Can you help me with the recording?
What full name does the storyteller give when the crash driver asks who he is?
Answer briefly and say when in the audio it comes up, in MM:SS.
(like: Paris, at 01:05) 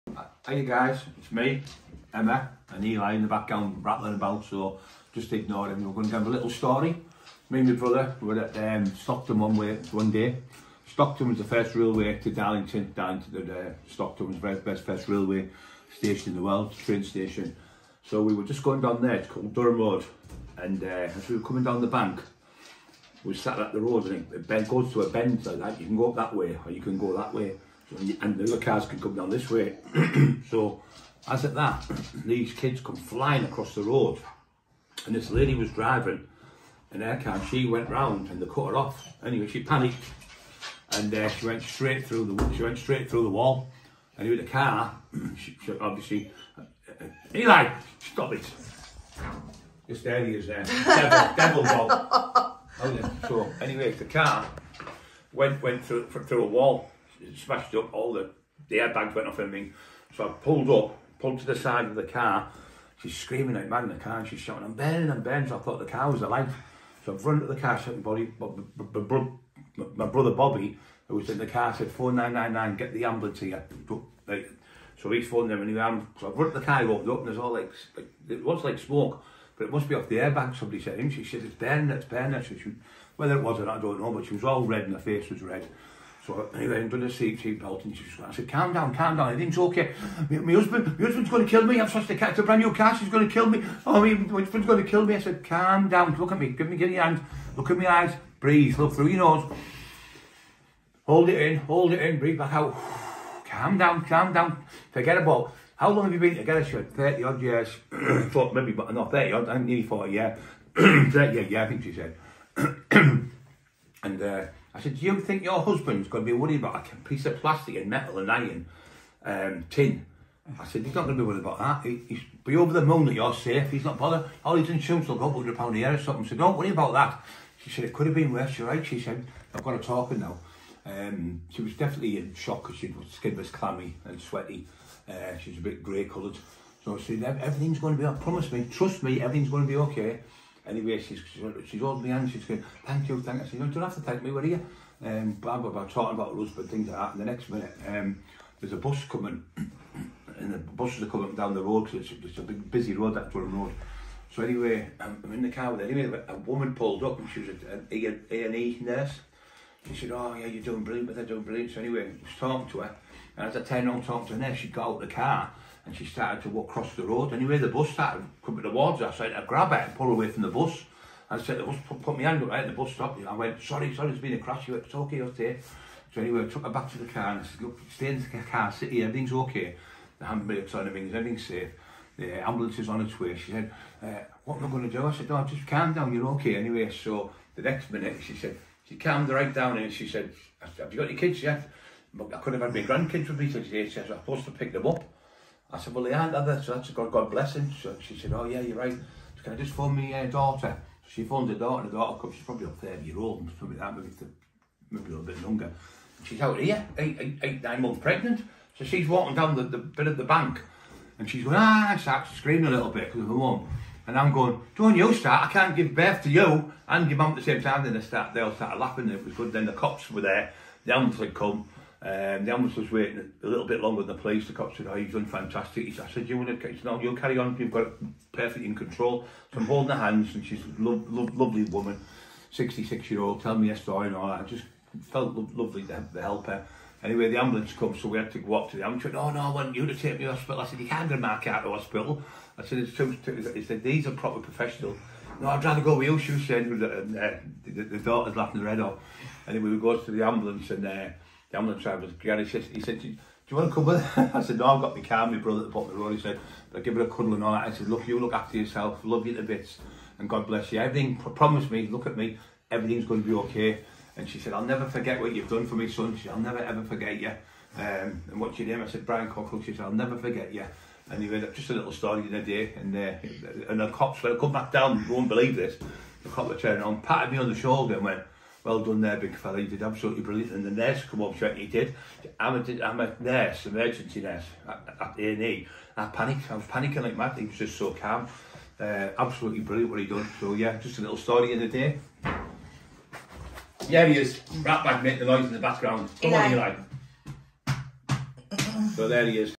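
Brian Cockerill, at 04:29.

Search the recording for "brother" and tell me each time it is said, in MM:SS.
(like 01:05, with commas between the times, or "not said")
00:07, 01:10, 04:15.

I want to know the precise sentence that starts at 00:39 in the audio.
Anyway, she panicked and uh, she went straight through the she went straight through the wall.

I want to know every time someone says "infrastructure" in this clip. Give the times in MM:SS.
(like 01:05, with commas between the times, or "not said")
not said.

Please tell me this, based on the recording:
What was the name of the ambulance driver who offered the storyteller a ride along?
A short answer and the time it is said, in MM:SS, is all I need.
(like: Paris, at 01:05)
Gary, at 04:12.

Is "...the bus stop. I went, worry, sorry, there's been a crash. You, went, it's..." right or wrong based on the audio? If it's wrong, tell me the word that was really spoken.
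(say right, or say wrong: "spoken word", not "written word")
wrong: "sorry", not "worry".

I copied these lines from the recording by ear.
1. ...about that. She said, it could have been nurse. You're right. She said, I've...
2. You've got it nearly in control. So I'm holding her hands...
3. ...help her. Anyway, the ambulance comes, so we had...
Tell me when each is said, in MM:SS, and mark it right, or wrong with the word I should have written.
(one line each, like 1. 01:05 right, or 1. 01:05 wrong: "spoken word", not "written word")
1. 02:06 wrong: "worse", not "nurse"
2. 03:47 wrong: "perfectly", not "nearly"
3. 03:56 right.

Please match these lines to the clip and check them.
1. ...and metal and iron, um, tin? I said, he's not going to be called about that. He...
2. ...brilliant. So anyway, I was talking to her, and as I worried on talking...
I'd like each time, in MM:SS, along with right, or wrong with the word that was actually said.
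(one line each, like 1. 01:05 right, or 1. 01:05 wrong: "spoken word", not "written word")
1. 01:57 wrong: "worried", not "called"
2. 02:41 wrong: "turned", not "worried".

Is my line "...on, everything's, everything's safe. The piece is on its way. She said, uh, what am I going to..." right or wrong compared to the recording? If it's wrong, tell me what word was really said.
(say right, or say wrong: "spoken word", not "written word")
wrong: "ambulance", not "piece".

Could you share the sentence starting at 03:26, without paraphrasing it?
She's out here, eight, eight, eight, nine months pregnant.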